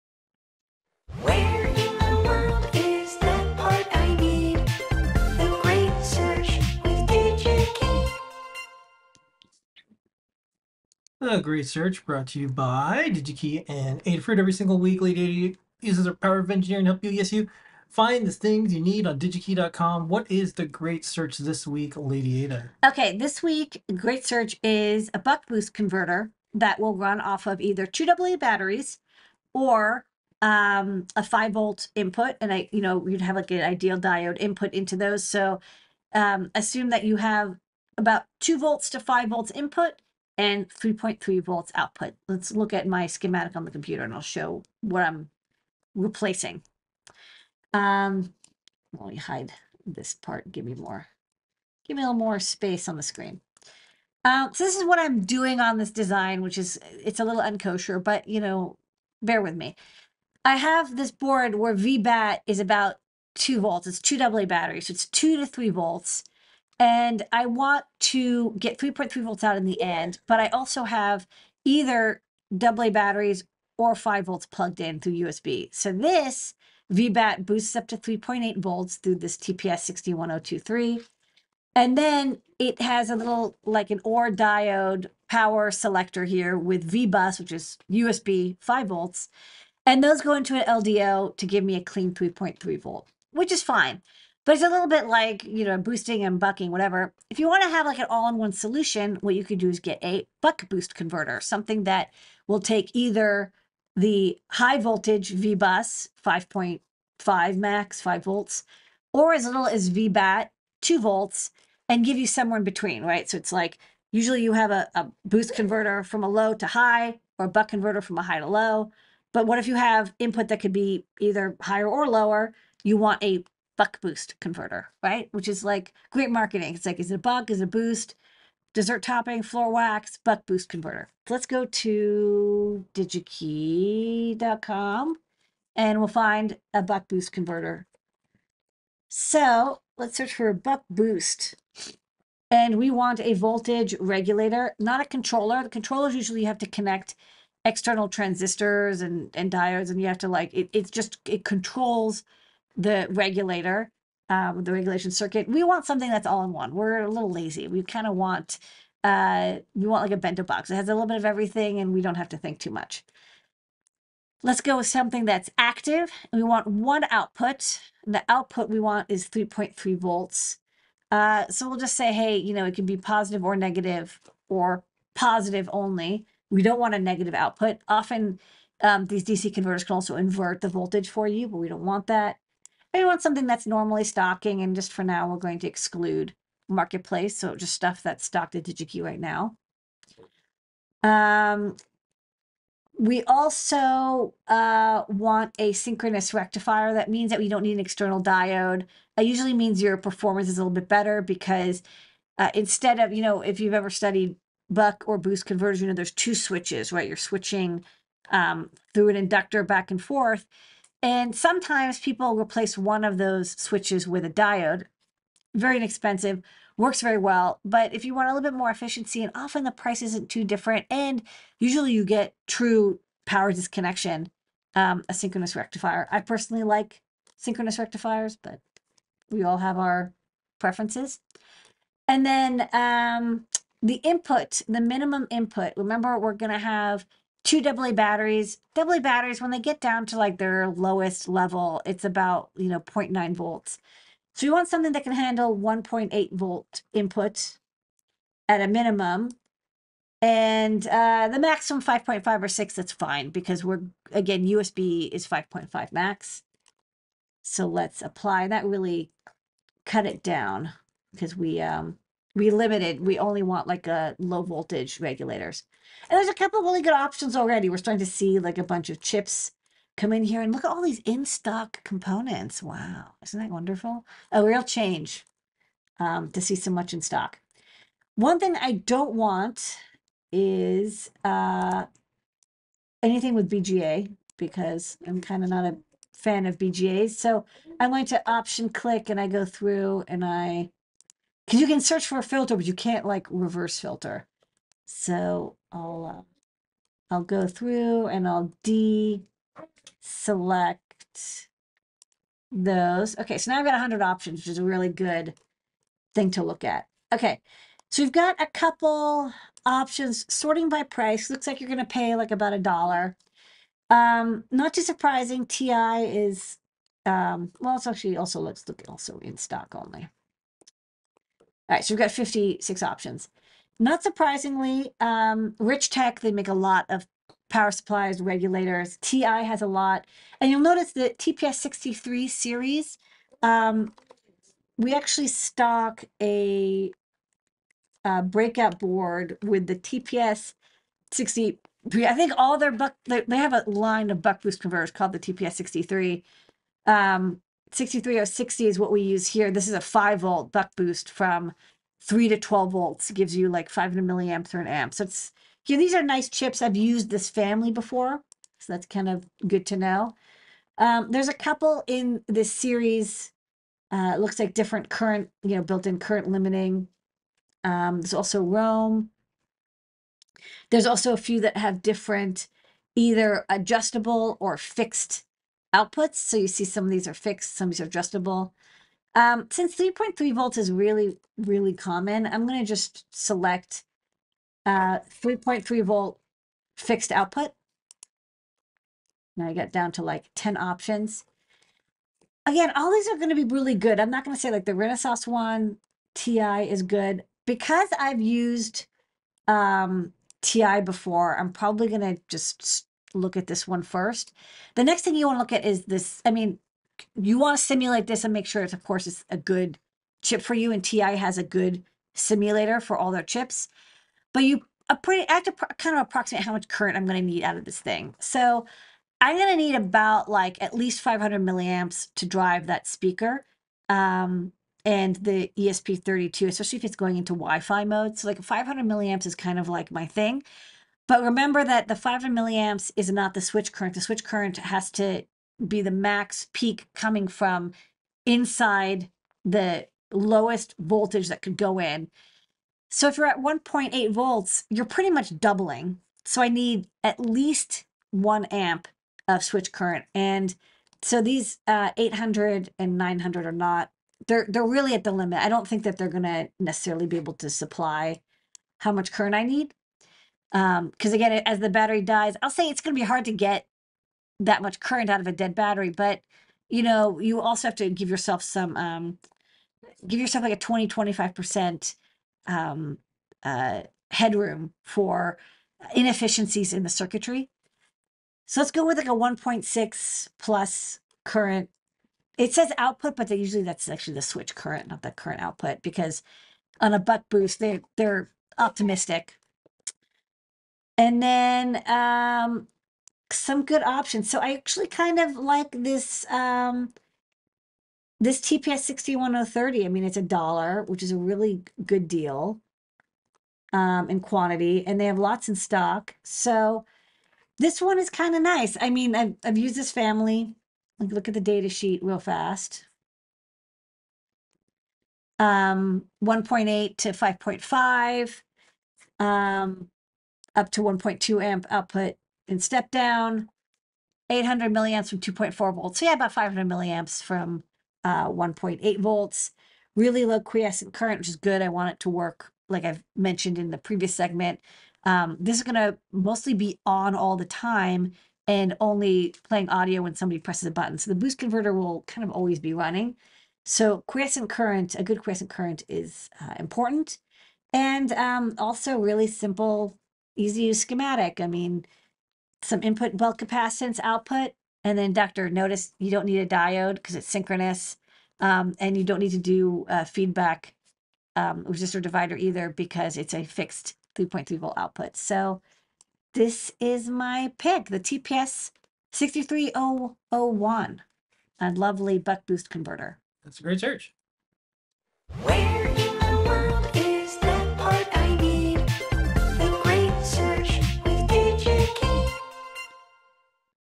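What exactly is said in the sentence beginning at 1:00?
I have this board where VBAT is about two volts.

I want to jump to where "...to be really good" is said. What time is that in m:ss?
6:33.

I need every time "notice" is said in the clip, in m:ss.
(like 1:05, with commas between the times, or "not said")
5:30, 9:15.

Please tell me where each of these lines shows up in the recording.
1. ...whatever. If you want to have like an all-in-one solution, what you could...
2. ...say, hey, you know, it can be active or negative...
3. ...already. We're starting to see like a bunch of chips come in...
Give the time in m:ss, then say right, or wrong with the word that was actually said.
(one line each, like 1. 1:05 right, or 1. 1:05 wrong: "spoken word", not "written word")
1. 1:36 right
2. 2:51 wrong: "positive", not "active"
3. 4:27 right.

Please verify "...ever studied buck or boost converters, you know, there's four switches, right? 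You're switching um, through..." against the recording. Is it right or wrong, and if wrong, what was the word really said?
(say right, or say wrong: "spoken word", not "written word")
wrong: "two", not "four".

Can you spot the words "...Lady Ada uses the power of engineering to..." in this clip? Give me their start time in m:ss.
0:15.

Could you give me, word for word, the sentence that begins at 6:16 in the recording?
So you see some of these are fixed, some of these are adjustable.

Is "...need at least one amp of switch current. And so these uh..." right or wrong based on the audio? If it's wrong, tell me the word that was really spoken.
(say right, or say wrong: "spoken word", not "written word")
right.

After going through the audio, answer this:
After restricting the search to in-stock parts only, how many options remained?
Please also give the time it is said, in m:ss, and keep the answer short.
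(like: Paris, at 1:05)
56, at 5:22.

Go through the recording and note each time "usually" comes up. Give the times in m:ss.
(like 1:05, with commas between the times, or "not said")
1:54, 2:26, 3:19, 3:41, 8:03.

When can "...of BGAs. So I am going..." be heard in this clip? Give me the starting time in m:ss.
4:46.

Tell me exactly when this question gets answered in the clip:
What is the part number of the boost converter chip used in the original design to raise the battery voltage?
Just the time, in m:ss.
1:19.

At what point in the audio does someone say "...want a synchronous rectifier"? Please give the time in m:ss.
3:15.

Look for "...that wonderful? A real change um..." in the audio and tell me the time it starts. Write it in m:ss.
4:33.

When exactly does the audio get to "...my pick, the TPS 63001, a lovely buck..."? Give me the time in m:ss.
9:27.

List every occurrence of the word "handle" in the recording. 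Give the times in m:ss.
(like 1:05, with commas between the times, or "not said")
4:05.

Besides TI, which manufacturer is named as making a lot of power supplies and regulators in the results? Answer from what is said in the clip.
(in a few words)
Richtek.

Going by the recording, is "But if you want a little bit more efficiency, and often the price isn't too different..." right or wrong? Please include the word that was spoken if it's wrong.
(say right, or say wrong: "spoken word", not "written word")
right.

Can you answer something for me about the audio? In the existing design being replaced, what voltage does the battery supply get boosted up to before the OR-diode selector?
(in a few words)
3.8 volts.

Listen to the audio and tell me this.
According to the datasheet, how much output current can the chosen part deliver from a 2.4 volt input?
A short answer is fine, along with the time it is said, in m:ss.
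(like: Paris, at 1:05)
800 milliamps, at 8:44.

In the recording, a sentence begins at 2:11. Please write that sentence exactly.
Let's go to digikey.com and we'll find a buck boost converter.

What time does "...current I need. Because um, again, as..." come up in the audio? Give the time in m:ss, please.
7:39.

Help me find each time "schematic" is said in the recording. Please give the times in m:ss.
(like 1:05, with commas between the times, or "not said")
0:43, 9:10.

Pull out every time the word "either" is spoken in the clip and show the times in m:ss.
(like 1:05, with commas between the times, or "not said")
0:27, 1:11, 1:42, 2:01, 6:12, 9:22.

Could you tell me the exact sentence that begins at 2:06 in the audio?
It's like, is it a buck?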